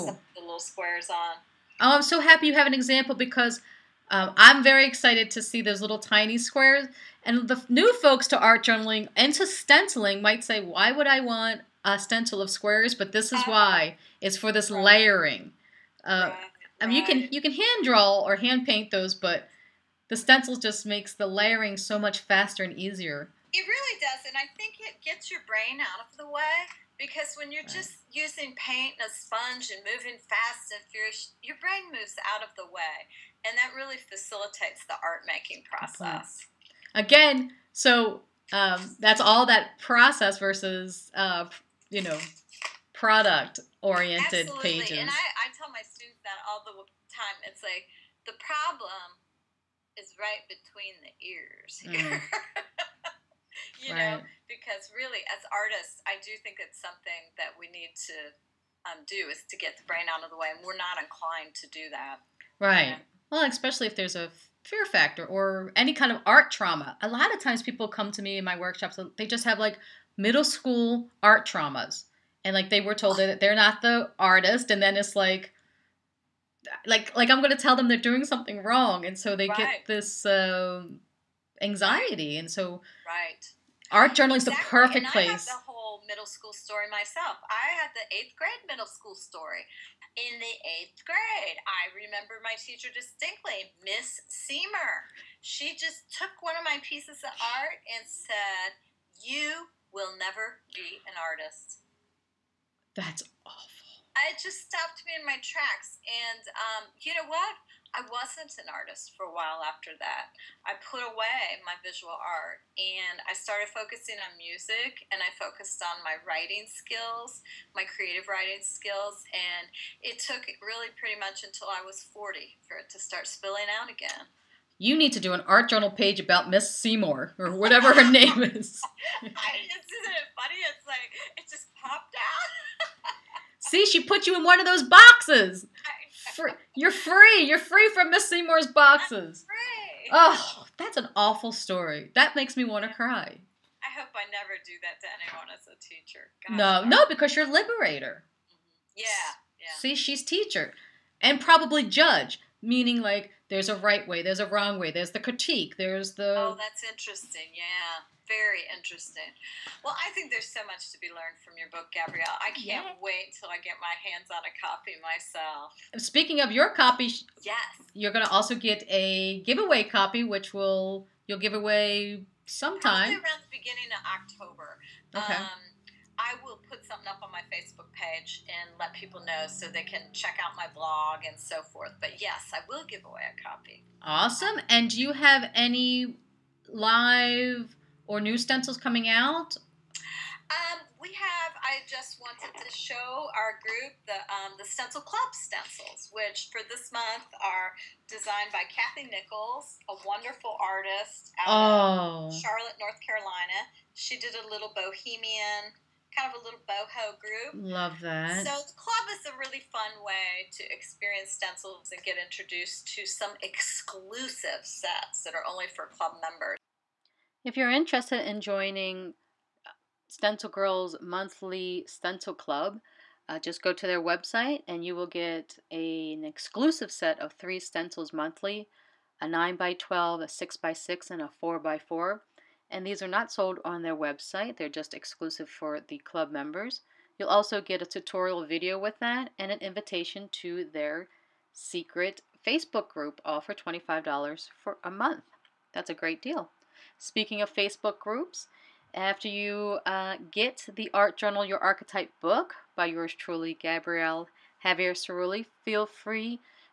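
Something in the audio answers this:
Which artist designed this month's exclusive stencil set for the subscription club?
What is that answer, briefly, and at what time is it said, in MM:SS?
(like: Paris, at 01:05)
Kathy Nichols, at 03:18.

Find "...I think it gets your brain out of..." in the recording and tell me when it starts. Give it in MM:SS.
00:24.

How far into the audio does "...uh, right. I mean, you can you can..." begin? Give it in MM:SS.
00:16.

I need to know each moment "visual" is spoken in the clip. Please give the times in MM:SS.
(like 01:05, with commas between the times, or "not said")
01:51.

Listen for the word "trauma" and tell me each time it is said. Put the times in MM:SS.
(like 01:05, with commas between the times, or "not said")
01:06, 01:11.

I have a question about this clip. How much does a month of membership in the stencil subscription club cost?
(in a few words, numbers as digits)
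$25.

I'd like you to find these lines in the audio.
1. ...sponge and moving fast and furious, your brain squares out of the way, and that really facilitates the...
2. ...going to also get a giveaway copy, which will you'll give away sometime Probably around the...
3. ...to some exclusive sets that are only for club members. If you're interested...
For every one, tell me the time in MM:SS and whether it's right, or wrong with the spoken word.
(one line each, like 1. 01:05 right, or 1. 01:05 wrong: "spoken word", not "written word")
1. 00:29 wrong: "moves", not "squares"
2. 02:48 right
3. 03:32 right.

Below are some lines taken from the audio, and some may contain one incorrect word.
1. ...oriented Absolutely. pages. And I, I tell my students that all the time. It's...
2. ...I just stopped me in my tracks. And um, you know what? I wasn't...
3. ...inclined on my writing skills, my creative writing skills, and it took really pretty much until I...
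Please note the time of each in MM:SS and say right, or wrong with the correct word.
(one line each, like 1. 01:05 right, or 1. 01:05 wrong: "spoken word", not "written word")
1. 00:43 right
2. 01:44 right
3. 01:55 wrong: "focused", not "inclined".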